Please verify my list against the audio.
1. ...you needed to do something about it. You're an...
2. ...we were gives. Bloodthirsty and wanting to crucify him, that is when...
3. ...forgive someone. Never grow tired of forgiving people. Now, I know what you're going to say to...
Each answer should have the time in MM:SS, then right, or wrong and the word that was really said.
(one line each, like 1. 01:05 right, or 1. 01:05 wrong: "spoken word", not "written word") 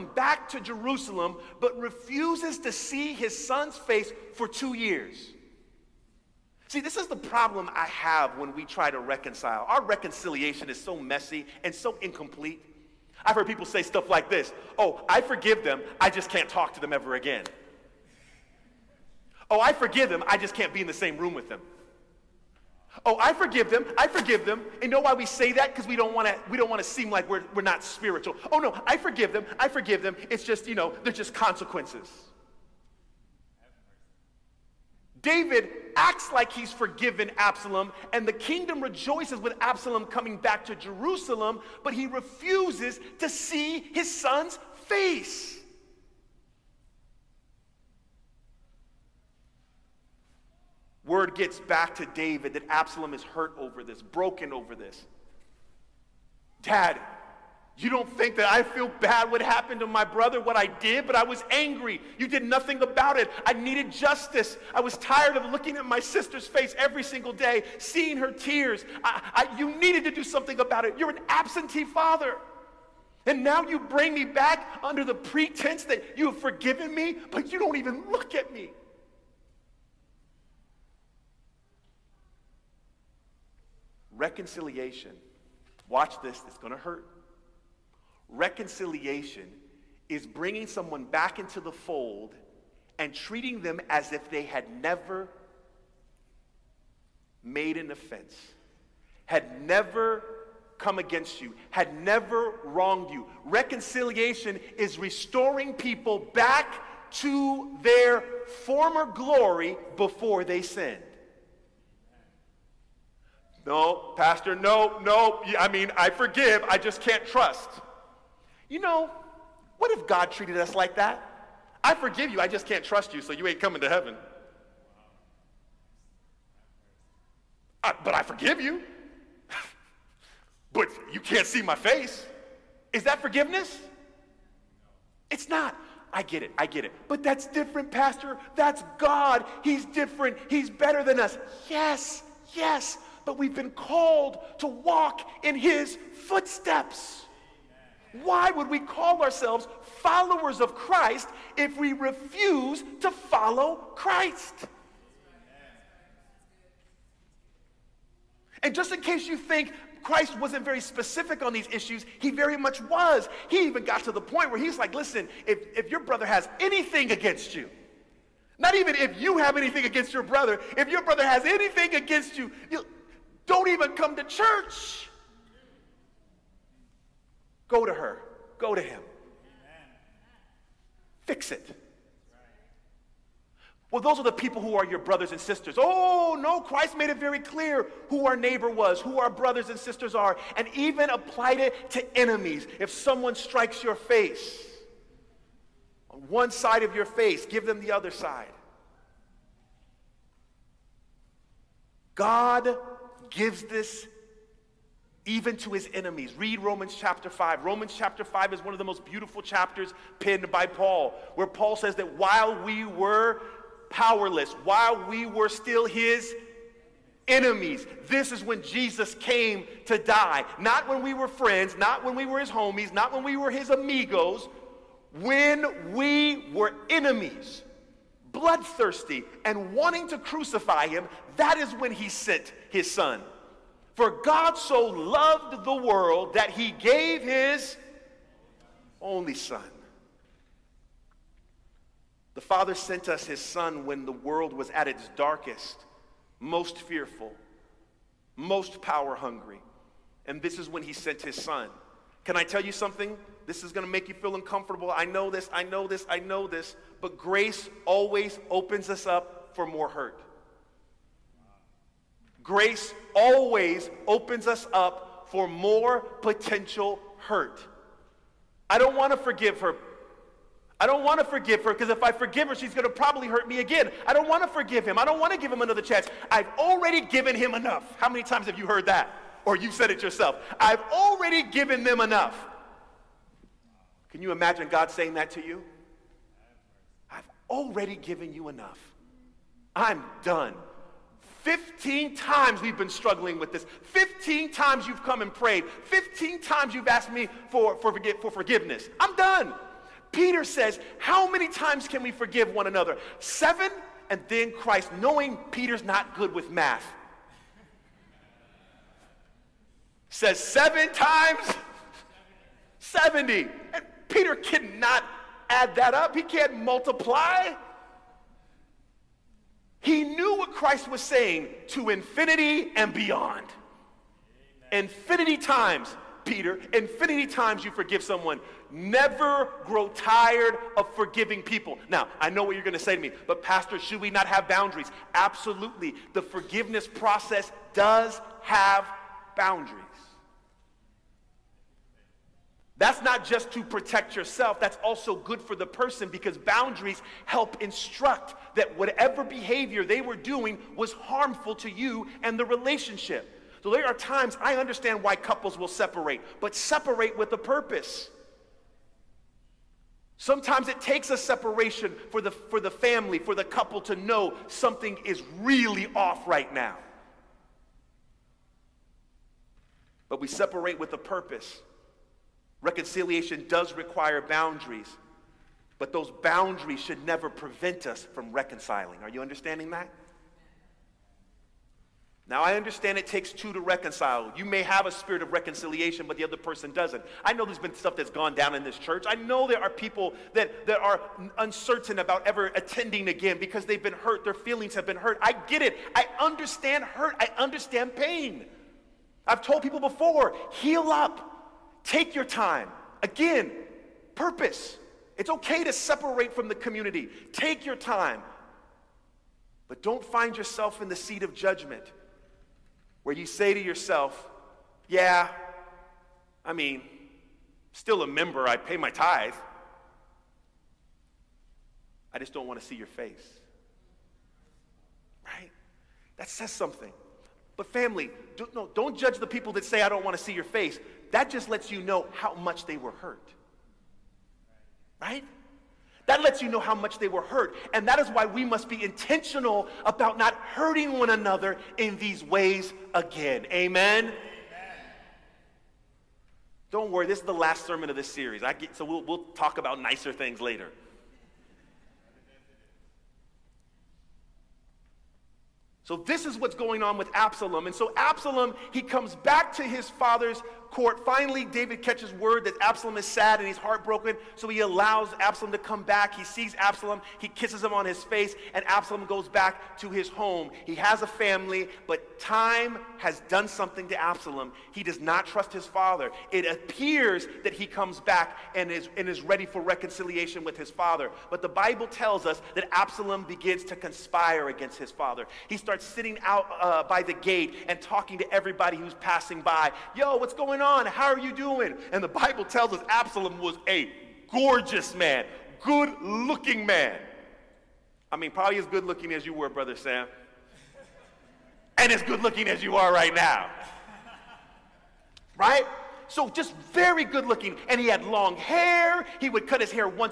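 1. 01:09 right
2. 03:45 wrong: "enemies", not "gives"
3. 05:27 right.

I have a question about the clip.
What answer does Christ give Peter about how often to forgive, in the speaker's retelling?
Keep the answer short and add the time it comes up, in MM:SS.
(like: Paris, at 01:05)
7 times 70, at 05:10.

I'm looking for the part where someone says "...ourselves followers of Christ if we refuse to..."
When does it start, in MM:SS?
02:29.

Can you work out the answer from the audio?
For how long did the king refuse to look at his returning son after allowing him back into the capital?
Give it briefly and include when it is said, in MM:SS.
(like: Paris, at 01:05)
2 years, at 00:04.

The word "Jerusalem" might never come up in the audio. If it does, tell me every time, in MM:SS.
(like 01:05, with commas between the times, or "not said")
00:00, 00:40.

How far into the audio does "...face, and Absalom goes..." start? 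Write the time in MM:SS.
07:48.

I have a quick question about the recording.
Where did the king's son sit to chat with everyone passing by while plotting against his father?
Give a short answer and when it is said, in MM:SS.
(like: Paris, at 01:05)
by the gate, at 08:06.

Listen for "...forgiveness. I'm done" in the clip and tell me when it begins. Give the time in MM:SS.
04:58.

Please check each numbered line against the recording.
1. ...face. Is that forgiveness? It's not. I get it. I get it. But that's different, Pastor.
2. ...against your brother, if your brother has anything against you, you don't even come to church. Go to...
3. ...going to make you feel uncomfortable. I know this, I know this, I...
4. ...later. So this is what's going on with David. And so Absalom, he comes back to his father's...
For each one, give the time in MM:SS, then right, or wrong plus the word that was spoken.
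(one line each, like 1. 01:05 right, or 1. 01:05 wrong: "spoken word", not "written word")
1. 02:11 right
2. 02:49 right
3. 04:13 right
4. 07:30 wrong: "Absalom", not "David".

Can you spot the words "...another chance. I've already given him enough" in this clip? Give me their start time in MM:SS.
04:35.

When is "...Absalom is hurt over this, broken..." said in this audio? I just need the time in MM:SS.
00:52.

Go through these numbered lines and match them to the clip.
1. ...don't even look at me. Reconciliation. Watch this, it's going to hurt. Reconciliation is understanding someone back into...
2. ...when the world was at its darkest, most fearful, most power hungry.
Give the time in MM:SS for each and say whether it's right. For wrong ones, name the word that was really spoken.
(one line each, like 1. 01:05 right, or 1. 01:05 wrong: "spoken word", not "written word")
1. 01:17 wrong: "bringing", not "understanding"
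2. 04:03 right.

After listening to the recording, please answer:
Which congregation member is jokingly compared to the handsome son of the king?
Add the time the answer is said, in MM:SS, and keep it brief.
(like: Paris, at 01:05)
Brother Sam, at 08:19.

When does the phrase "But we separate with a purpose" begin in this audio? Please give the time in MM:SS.
06:10.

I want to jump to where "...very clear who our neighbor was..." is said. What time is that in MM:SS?
03:07.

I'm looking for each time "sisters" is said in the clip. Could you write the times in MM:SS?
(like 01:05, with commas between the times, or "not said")
01:05, 03:05, 03:09.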